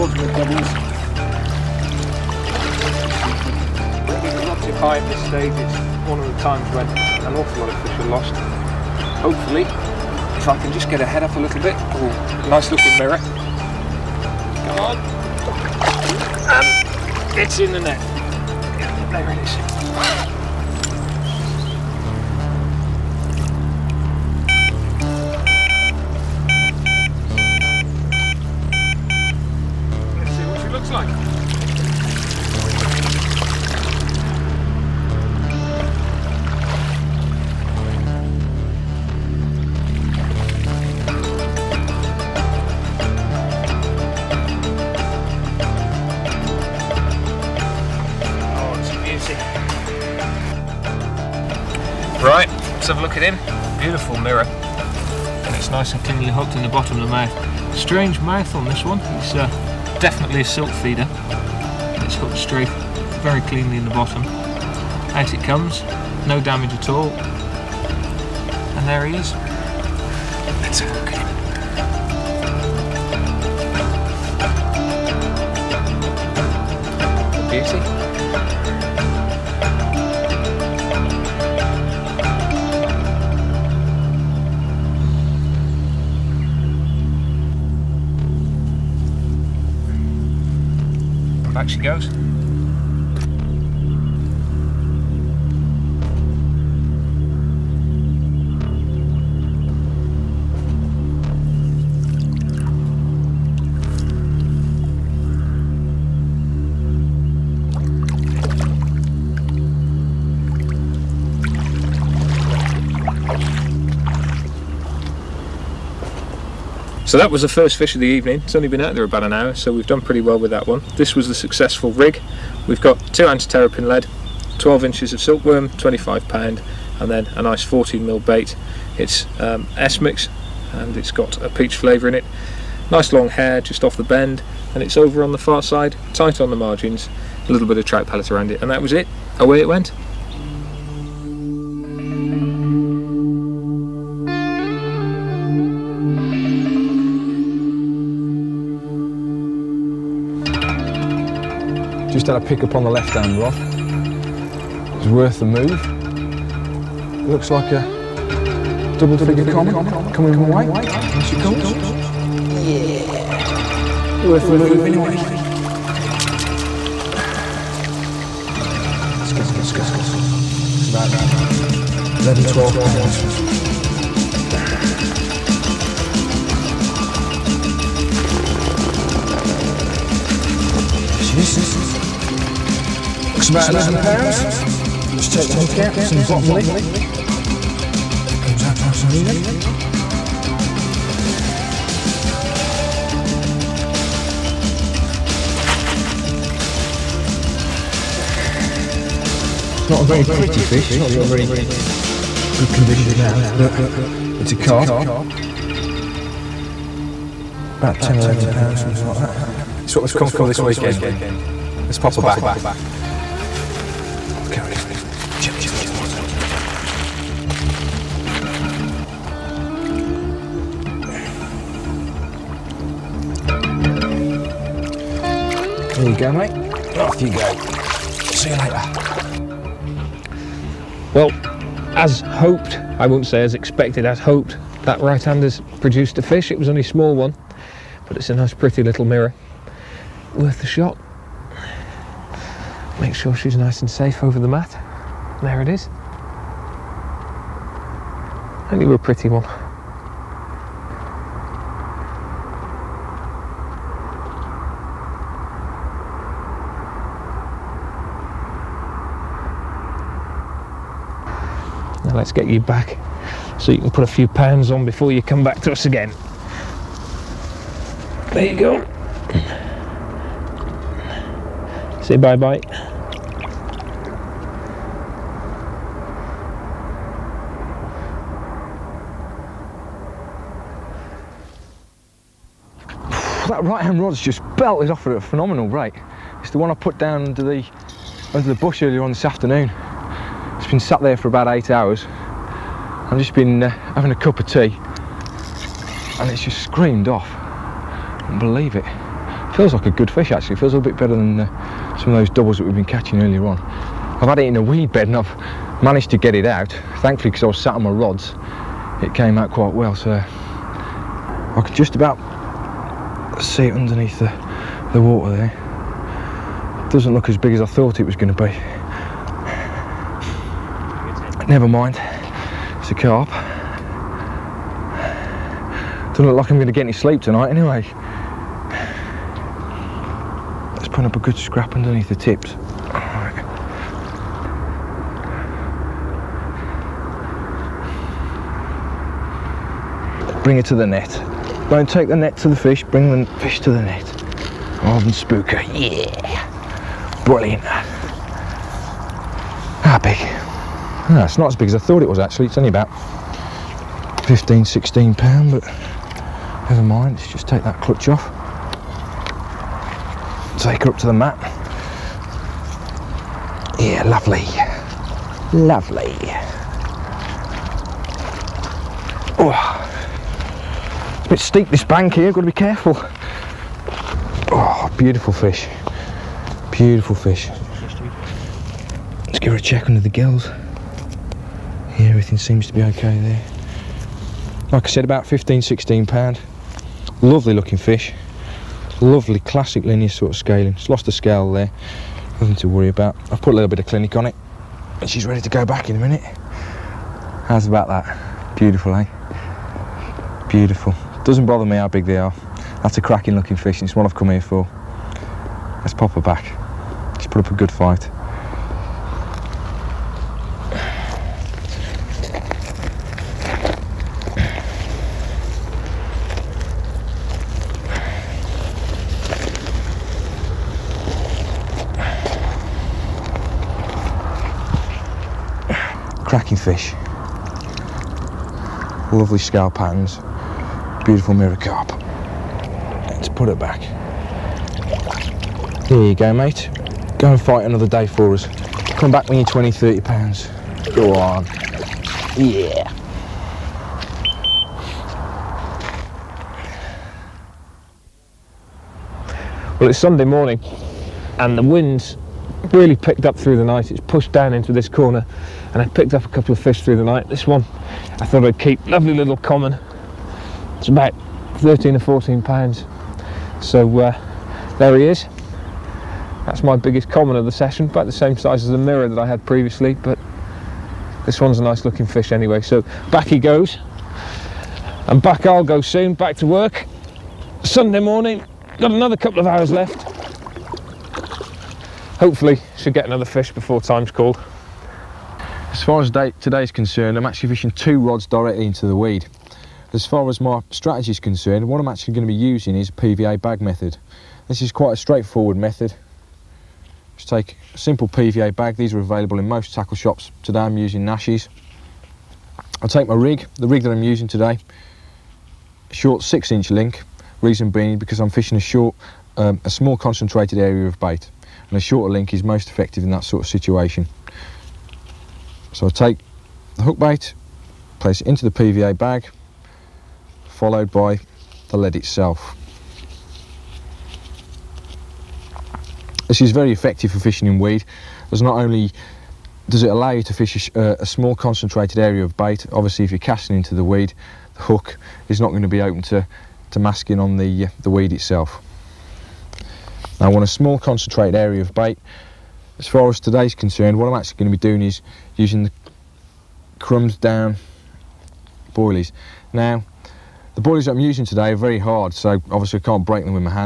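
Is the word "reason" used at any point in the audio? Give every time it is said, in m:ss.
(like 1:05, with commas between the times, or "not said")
8:27.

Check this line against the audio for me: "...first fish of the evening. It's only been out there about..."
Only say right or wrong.
right.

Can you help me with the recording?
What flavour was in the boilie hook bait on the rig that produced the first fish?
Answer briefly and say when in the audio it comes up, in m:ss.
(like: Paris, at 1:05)
Peach, at 2:11.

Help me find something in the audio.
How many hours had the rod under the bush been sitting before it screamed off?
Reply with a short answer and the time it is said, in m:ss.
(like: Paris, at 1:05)
8, at 4:51.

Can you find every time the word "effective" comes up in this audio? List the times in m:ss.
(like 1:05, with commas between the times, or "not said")
8:32, 8:46.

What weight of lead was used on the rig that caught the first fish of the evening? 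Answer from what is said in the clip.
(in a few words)
2 ounce.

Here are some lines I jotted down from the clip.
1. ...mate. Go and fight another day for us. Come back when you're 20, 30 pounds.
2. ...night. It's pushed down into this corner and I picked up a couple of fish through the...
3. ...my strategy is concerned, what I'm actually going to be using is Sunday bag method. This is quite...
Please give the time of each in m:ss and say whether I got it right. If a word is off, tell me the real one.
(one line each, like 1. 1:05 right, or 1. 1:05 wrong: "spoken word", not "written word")
1. 7:16 right
2. 7:33 right
3. 8:10 wrong: "PVA", not "Sunday".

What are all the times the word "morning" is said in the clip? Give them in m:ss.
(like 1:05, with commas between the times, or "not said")
7:30, 7:58.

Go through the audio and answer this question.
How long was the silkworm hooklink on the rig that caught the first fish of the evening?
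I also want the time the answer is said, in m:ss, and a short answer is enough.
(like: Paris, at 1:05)
12 inches, at 2:04.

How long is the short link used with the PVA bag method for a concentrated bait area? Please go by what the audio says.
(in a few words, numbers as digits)
6 inch.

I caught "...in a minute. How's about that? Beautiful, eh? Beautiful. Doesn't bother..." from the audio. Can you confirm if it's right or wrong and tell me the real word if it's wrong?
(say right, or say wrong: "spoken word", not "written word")
right.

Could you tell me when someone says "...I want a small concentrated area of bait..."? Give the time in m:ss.
9:00.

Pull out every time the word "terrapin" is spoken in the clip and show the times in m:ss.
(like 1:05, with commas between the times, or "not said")
2:03.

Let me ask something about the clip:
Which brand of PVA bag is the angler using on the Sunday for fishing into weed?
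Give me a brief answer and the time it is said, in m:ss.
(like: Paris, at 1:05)
Nash, at 8:21.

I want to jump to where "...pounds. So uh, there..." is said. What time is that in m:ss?
7:42.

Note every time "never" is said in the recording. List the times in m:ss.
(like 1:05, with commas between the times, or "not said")
5:21, 5:56.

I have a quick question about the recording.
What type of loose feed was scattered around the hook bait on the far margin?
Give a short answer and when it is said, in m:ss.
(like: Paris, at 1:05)
Trout pellet, at 2:17.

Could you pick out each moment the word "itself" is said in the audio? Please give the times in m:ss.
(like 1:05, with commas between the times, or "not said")
8:41, 8:58.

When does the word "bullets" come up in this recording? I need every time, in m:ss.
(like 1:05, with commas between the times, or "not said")
not said.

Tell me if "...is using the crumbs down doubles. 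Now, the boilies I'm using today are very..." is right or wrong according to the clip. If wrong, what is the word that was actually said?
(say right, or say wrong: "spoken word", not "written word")
wrong: "boilies", not "doubles".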